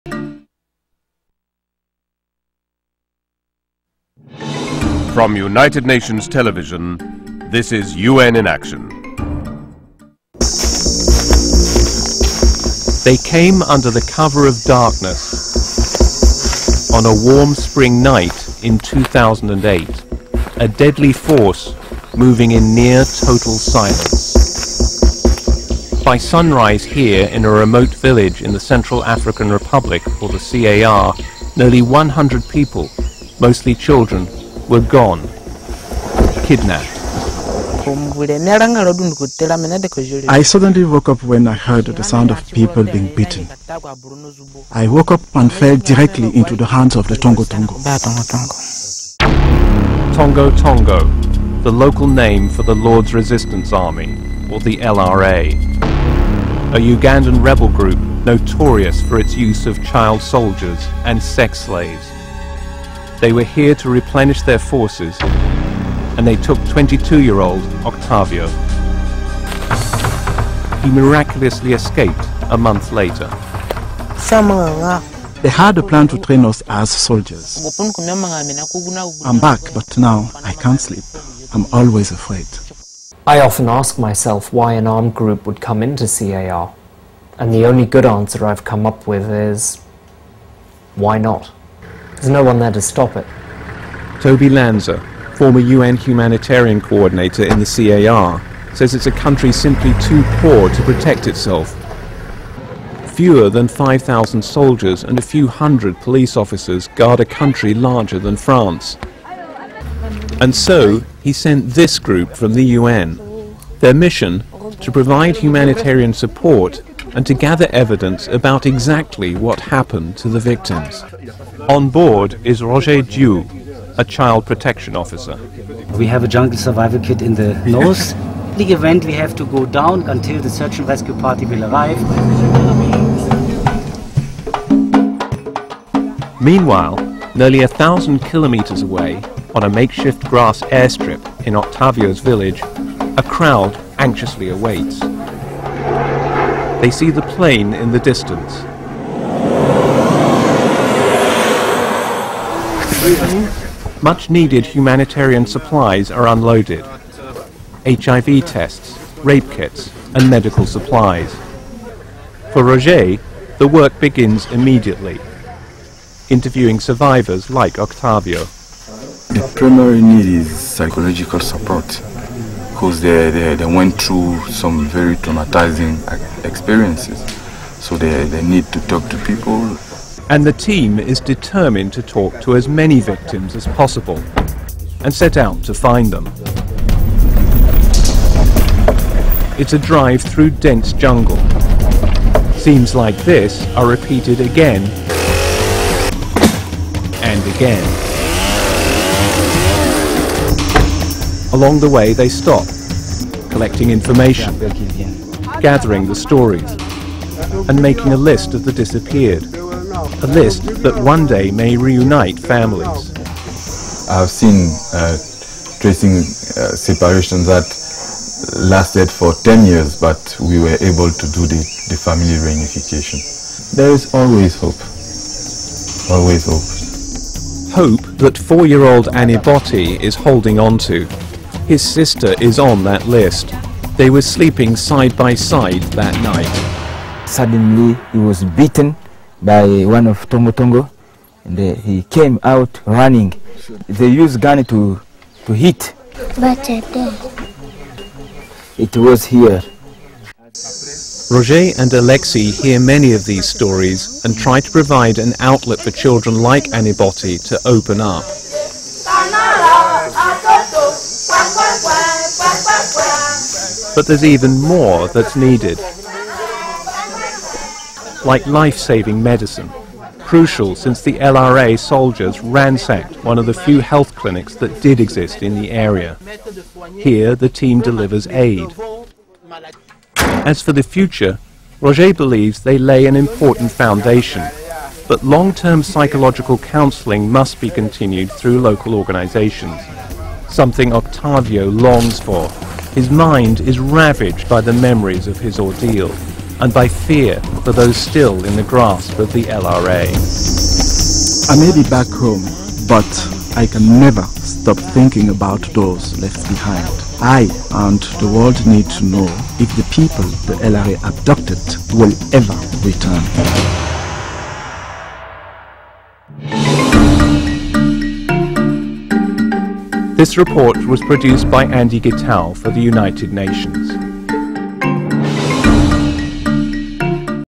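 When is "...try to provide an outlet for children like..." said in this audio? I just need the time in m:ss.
4:14.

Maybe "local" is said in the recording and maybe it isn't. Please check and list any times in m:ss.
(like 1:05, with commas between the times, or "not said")
0:51, 4:48.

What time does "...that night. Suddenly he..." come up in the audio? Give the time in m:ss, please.
3:55.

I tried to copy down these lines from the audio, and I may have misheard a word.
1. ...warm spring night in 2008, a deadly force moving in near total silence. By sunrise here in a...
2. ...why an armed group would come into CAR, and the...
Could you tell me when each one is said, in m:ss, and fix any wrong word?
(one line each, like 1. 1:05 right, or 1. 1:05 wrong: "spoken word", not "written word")
1. 0:17 right
2. 1:24 right.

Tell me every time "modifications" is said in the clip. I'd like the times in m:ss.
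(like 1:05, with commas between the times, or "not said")
not said.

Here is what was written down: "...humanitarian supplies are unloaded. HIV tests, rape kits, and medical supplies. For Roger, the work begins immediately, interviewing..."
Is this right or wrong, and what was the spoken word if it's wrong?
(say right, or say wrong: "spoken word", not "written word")
right.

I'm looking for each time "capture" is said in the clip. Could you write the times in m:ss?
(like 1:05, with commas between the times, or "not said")
not said.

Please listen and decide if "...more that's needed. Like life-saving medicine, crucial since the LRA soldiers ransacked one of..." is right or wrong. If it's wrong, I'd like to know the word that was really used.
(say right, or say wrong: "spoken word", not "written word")
right.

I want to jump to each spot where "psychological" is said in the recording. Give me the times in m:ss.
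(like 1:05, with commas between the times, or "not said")
2:50, 4:45.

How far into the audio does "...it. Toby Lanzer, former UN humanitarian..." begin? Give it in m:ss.
1:33.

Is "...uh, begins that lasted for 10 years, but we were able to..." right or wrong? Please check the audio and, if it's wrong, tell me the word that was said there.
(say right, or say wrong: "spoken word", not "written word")
wrong: "separations", not "begins".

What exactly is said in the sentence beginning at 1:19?
I'm back, but now I can't sleep.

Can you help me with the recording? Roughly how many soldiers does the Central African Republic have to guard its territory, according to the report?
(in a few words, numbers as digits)
5,000.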